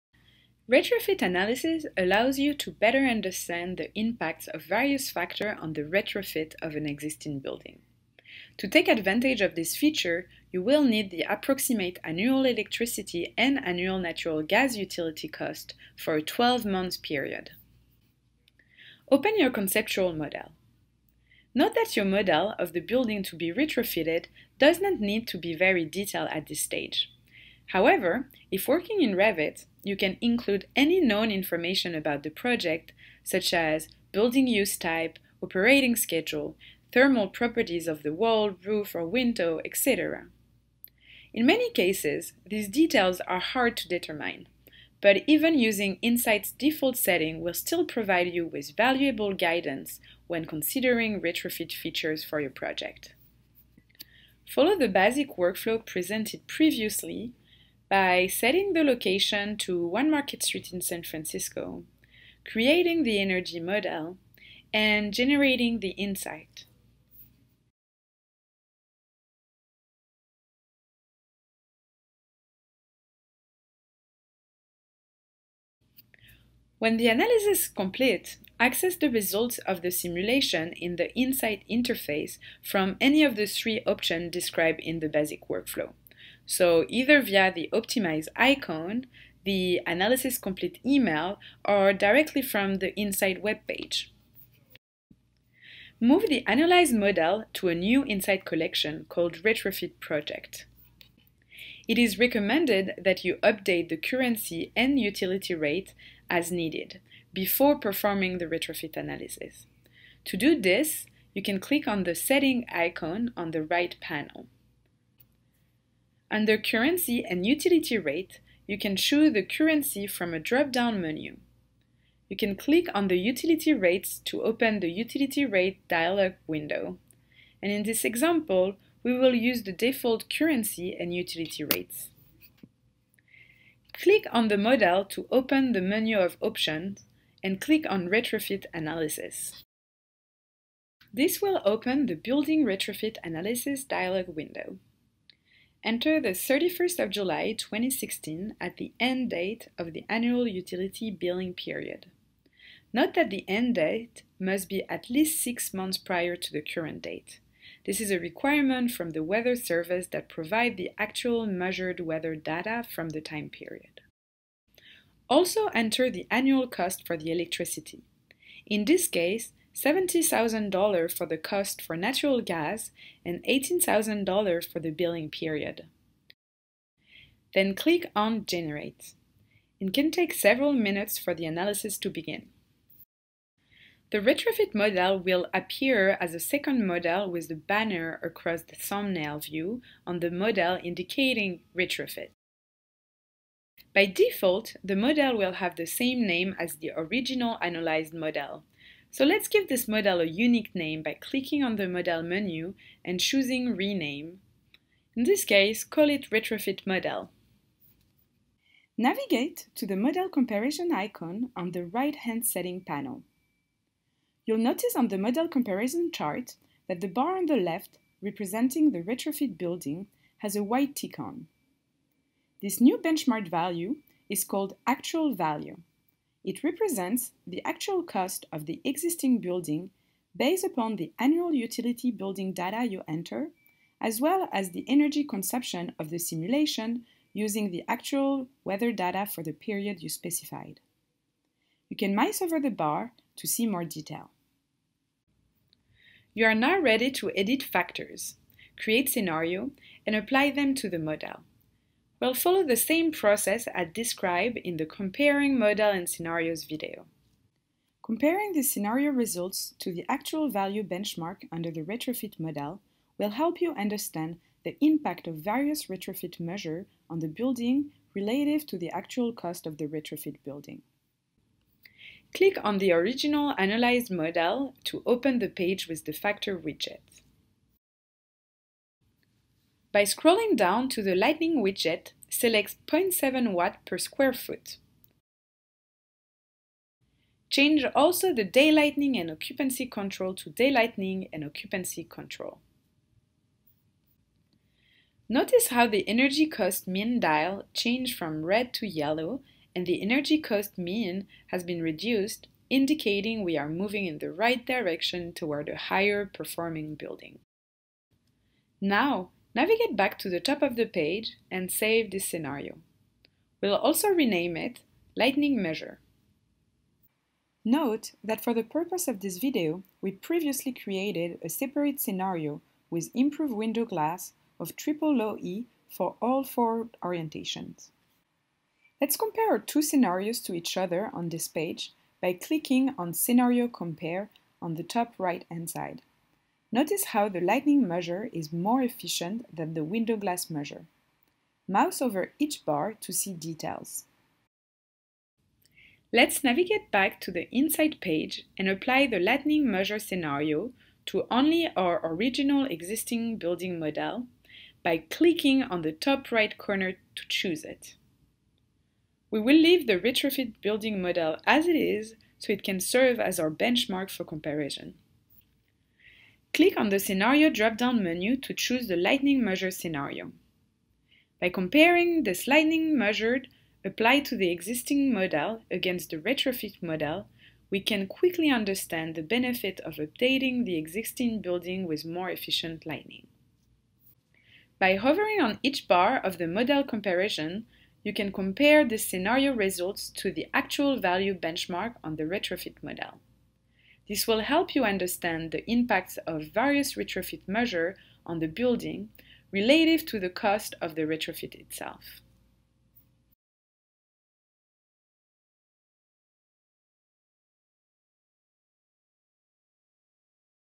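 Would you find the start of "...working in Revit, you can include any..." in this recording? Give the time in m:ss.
0:28.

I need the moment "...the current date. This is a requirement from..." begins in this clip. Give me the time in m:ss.
2:36.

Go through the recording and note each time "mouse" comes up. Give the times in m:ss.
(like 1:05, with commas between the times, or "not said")
4:02, 5:41.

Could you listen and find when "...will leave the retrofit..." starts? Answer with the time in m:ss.
5:59.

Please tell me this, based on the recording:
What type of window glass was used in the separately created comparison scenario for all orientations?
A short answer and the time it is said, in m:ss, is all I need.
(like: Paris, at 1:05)
triple low E, at 5:24.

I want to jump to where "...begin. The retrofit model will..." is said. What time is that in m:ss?
3:02.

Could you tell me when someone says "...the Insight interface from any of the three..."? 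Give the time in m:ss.
1:20.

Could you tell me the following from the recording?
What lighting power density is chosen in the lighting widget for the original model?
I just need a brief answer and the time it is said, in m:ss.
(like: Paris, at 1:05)
0.7 watt per square foot, at 4:42.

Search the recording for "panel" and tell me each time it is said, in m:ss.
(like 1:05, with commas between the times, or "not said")
1:54, 3:32.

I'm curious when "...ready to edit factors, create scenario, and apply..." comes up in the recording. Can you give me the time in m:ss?
4:06.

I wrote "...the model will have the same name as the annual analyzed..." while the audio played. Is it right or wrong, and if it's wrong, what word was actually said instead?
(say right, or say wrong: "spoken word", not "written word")
wrong: "original", not "annual".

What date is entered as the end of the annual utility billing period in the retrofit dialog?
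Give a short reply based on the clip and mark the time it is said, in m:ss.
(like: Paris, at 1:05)
31 July 2016, at 2:26.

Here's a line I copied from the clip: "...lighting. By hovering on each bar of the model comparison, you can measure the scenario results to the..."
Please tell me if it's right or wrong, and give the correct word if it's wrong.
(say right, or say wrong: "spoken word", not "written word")
wrong: "compare", not "measure".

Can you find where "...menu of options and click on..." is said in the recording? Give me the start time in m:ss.
2:15.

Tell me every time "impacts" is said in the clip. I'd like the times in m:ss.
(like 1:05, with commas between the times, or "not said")
0:03, 4:24, 6:35.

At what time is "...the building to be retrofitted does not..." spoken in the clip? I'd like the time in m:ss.
0:22.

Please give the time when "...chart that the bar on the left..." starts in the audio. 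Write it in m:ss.
3:36.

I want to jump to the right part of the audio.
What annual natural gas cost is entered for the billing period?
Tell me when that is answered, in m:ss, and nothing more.
2:53.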